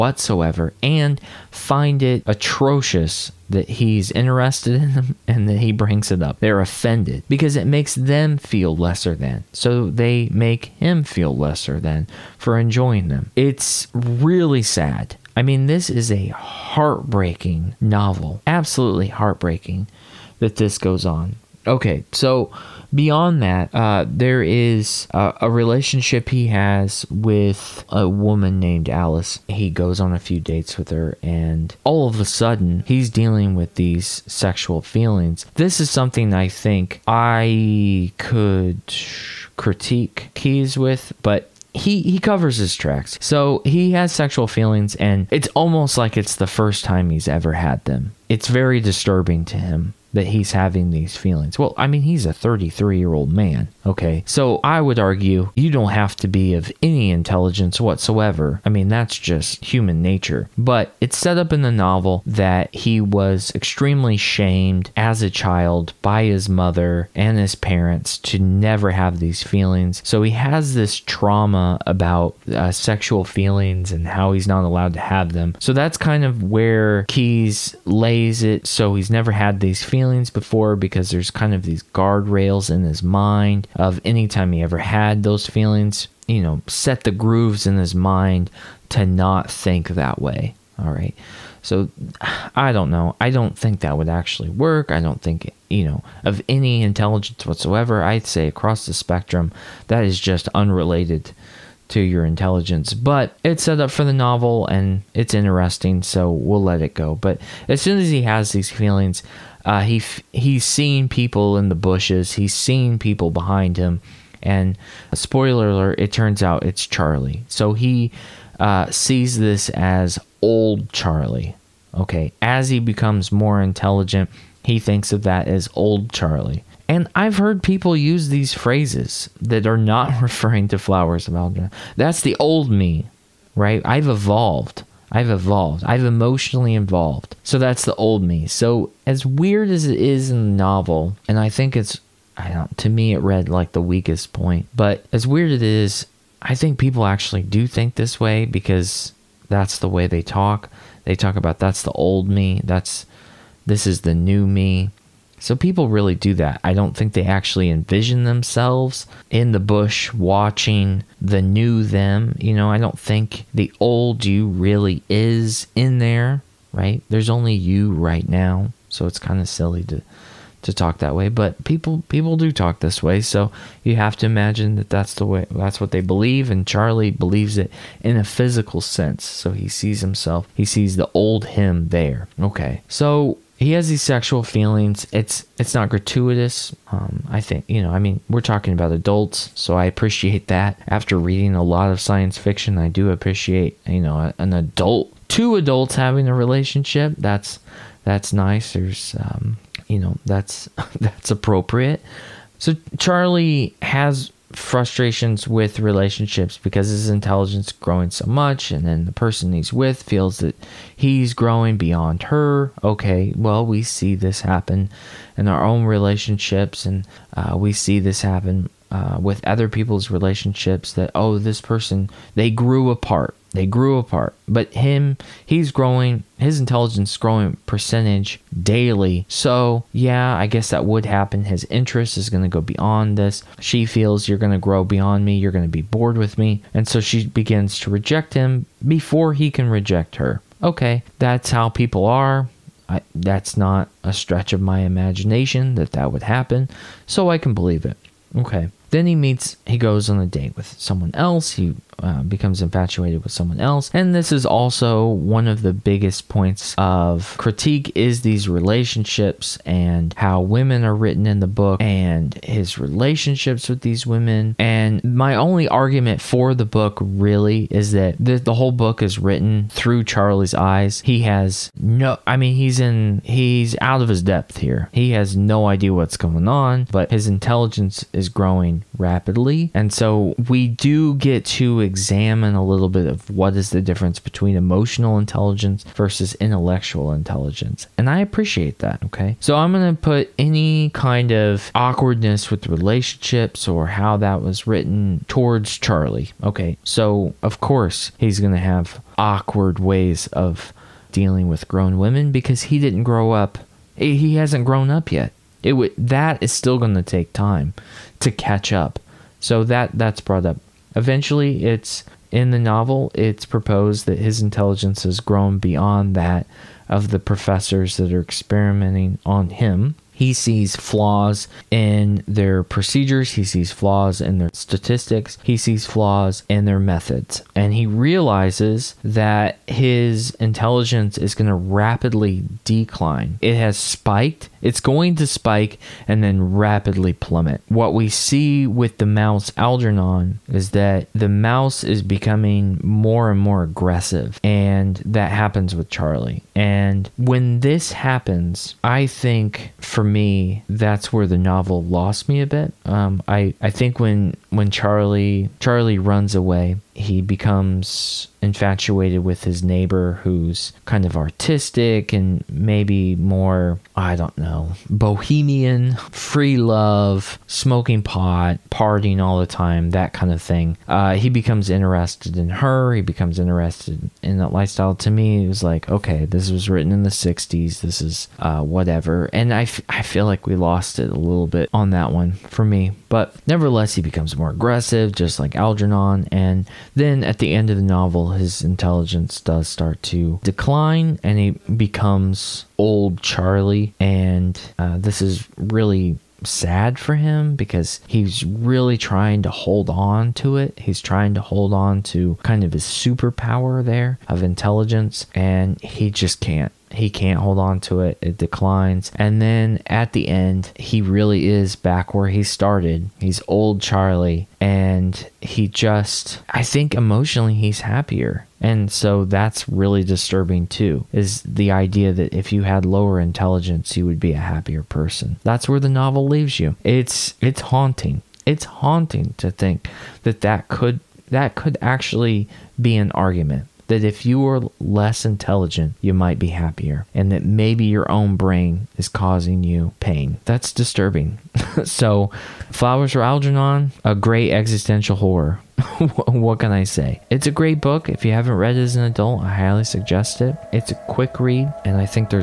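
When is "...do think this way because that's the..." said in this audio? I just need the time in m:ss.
2:27.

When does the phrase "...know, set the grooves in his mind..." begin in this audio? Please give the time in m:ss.
1:26.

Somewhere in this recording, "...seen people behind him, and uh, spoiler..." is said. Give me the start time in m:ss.
1:52.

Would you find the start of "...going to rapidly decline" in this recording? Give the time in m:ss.
5:31.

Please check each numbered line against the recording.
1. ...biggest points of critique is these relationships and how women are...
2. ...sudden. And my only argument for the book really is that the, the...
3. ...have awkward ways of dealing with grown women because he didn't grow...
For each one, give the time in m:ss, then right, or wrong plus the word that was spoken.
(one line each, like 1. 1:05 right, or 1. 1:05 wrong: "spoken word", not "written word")
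1. 4:15 right
2. 4:24 wrong: "women", not "sudden"
3. 4:58 right.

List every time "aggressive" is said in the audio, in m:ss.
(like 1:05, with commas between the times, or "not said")
5:43, 6:24.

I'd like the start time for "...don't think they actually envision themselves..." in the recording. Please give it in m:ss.
2:36.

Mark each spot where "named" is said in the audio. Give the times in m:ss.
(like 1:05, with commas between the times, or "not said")
0:28.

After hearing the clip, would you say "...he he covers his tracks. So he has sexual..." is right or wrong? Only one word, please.
right.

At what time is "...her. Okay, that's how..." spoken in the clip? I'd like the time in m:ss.
4:00.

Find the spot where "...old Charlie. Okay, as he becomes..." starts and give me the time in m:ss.
2:00.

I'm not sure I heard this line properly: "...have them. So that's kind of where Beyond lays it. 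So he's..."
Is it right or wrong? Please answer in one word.
wrong.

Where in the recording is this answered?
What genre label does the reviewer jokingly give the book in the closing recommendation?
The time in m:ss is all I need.
7:24.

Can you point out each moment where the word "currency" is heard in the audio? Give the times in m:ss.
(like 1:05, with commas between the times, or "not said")
not said.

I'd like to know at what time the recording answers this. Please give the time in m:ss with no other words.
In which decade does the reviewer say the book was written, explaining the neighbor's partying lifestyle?
6:17.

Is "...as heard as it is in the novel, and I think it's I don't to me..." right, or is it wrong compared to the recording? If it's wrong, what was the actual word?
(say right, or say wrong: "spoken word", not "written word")
wrong: "weird", not "heard".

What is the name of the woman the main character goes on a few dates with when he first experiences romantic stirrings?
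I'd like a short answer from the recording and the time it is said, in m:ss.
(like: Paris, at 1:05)
Alice, at 0:28.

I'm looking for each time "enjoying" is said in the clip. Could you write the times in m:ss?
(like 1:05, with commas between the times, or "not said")
0:12.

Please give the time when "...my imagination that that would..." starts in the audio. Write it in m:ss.
4:04.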